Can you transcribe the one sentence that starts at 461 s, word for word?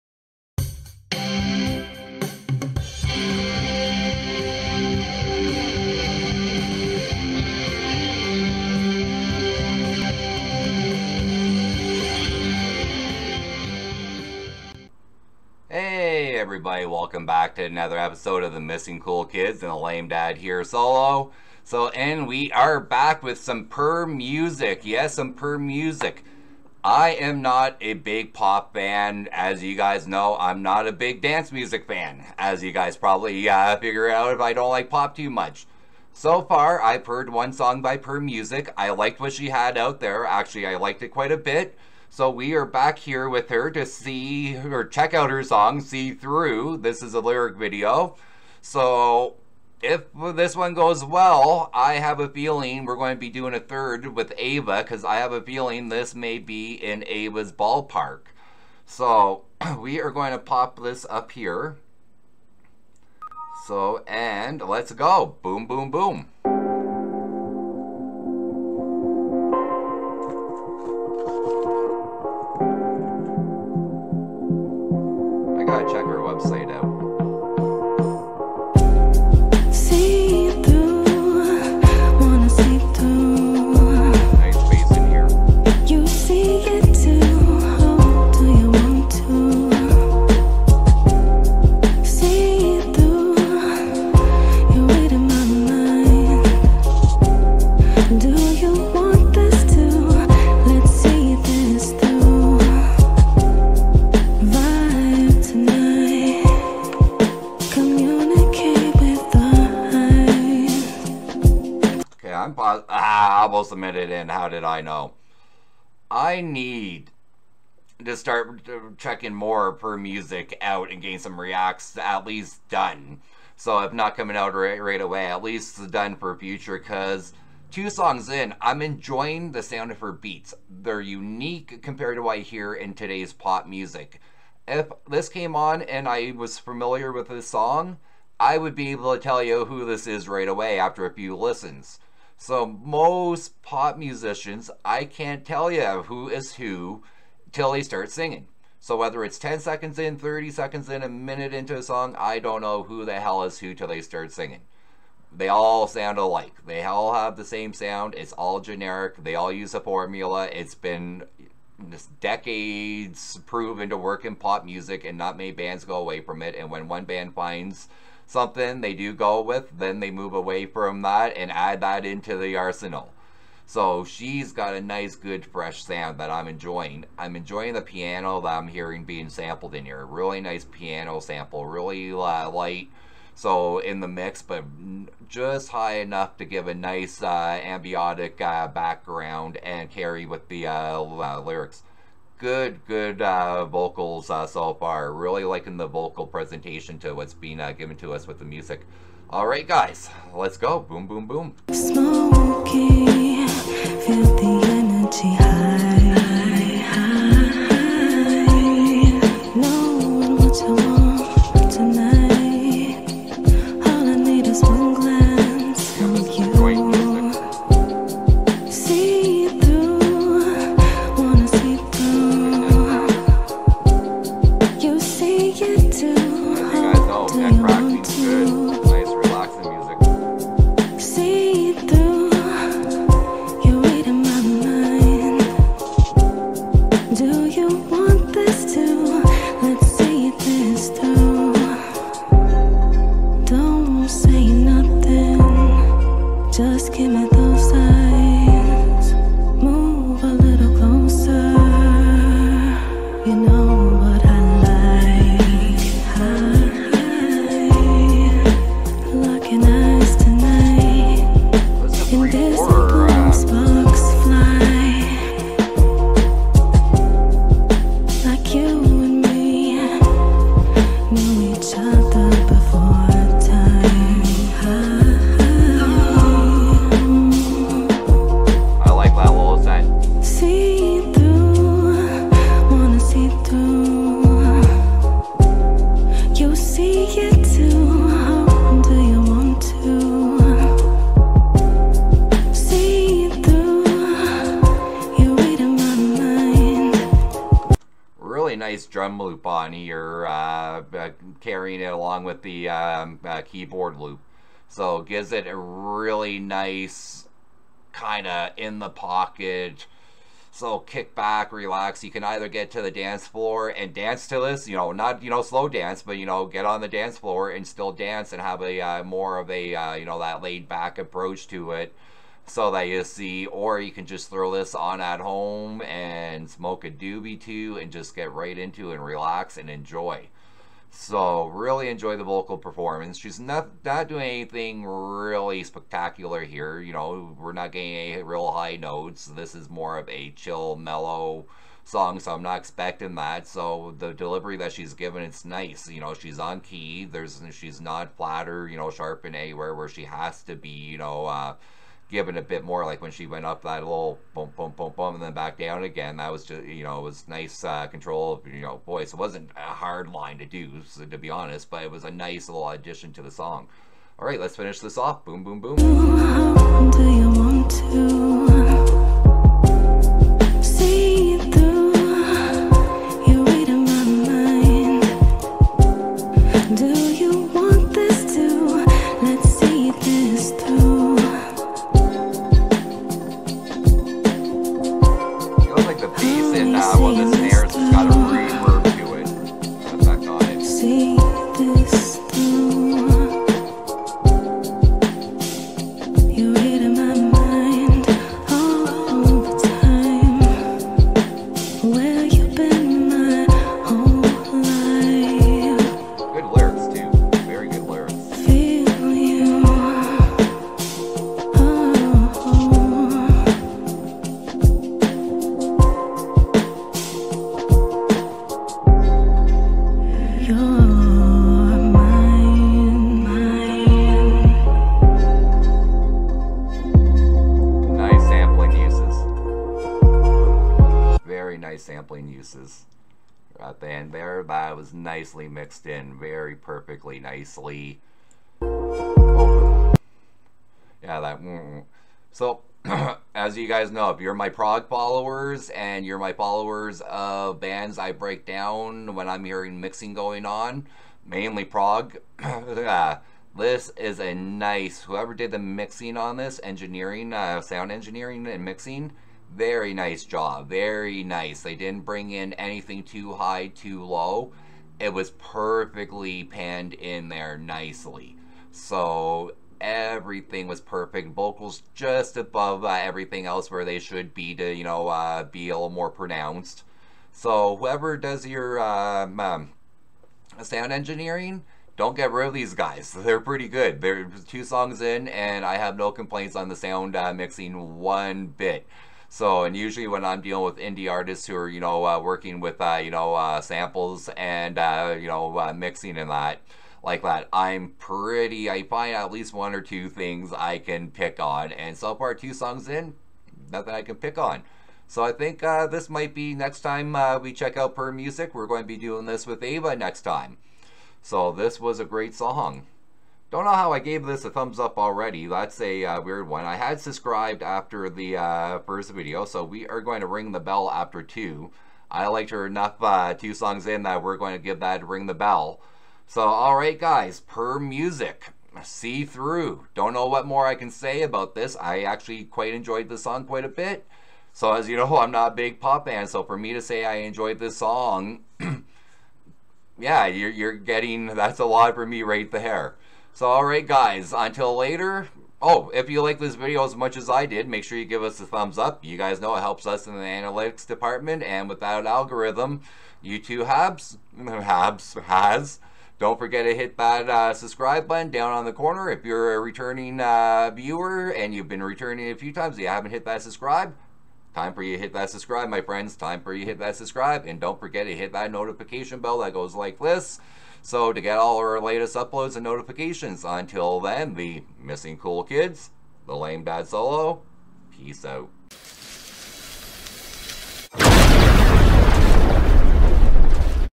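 They didn't bring in anything too high, too low.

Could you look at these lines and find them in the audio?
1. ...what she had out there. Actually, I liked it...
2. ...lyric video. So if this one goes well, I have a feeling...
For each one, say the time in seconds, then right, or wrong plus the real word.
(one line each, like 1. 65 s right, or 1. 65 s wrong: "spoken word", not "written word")
1. 39 s right
2. 47 s right.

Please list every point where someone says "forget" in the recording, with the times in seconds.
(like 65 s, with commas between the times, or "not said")
556 s, 567 s.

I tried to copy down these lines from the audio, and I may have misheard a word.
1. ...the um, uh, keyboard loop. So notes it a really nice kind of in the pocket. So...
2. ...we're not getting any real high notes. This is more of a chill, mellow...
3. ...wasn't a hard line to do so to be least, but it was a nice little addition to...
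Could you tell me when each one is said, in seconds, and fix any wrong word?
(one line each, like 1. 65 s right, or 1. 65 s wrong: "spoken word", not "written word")
1. 302 s wrong: "gives", not "notes"
2. 337 s right
3. 359 s wrong: "honest", not "least".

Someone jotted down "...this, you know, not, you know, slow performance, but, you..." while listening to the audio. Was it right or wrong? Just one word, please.
wrong.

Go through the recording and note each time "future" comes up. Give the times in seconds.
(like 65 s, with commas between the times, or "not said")
126 s.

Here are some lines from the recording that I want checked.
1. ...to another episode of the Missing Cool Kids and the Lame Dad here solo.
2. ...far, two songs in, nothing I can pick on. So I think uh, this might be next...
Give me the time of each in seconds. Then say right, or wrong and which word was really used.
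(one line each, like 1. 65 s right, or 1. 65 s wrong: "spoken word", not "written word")
1. 17 s right
2. 502 s right.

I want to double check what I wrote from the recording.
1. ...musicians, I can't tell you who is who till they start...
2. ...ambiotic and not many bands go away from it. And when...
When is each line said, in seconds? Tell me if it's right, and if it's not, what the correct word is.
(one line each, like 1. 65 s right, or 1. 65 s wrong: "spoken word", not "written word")
1. 143 s right
2. 164 s wrong: "music", not "ambiotic".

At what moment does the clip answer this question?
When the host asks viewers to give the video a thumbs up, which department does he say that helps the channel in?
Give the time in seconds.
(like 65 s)
550 s.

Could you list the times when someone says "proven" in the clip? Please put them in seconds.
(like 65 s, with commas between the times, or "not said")
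163 s.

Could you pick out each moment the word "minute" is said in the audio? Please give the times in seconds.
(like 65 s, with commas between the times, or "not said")
113 s, 151 s.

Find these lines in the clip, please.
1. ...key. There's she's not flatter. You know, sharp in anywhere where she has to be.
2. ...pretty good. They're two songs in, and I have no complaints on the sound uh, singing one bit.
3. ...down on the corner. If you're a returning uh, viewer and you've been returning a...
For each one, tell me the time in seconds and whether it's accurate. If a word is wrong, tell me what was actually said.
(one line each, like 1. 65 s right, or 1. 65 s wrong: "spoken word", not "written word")
1. 346 s right
2. 483 s wrong: "mixing", not "singing"
3. 558 s right.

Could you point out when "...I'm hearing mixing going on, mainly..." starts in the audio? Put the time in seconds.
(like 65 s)
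449 s.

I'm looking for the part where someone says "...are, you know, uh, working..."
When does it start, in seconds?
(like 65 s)
491 s.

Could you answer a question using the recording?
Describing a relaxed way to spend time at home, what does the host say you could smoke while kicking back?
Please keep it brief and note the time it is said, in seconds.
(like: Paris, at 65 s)
a doobie, at 326 s.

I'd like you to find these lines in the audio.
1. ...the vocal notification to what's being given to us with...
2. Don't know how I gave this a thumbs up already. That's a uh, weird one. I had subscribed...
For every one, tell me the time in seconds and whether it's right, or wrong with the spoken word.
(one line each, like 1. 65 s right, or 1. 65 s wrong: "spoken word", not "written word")
1. 195 s wrong: "presentation", not "notification"
2. 513 s right.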